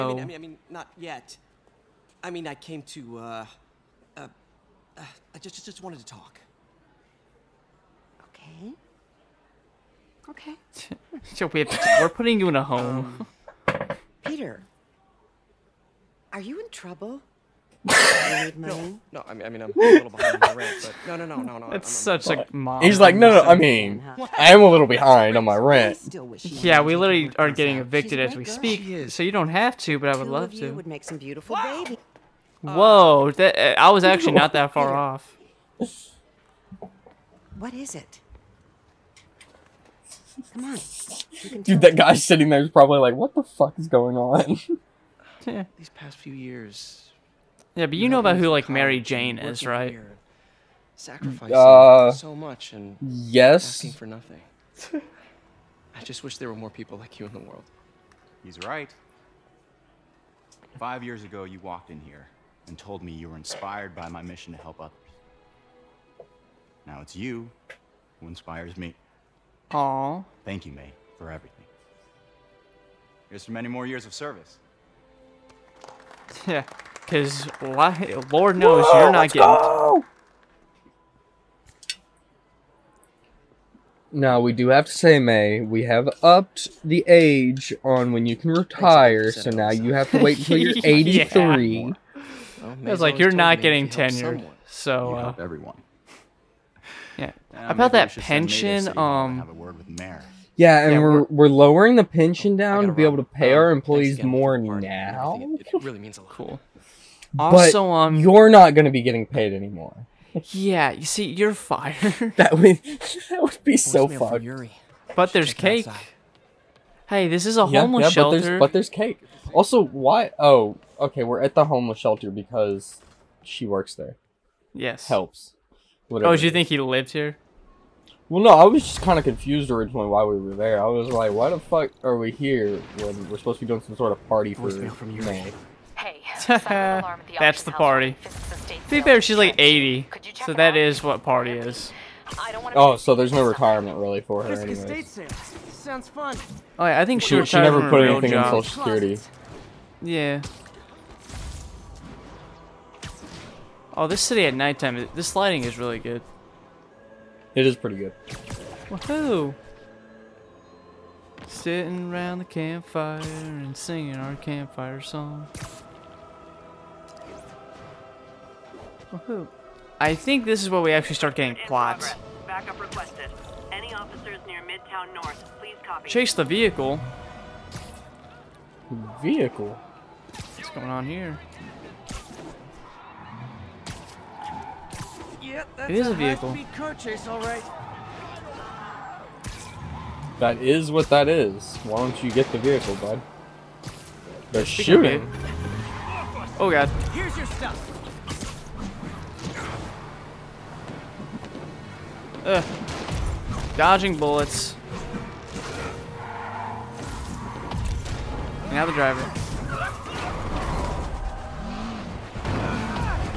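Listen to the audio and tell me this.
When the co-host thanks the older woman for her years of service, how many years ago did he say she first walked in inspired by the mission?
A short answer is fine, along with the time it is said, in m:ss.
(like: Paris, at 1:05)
5, at 1:00.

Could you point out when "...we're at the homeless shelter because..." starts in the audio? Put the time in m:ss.
2:01.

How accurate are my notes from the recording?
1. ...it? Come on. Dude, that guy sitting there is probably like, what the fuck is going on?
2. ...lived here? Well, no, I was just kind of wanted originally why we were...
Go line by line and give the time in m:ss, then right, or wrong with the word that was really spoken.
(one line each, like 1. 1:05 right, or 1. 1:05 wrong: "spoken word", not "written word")
1. 0:37 right
2. 2:06 wrong: "confused", not "wanted".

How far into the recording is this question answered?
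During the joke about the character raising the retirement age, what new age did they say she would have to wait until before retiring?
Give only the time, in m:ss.
1:30.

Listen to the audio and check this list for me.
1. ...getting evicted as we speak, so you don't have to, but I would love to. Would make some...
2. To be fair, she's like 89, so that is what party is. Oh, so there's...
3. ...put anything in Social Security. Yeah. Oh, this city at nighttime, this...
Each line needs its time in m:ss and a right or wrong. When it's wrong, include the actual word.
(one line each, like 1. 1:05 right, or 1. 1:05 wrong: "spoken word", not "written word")
1. 0:27 right
2. 2:18 wrong: "80", not "89"
3. 2:27 right.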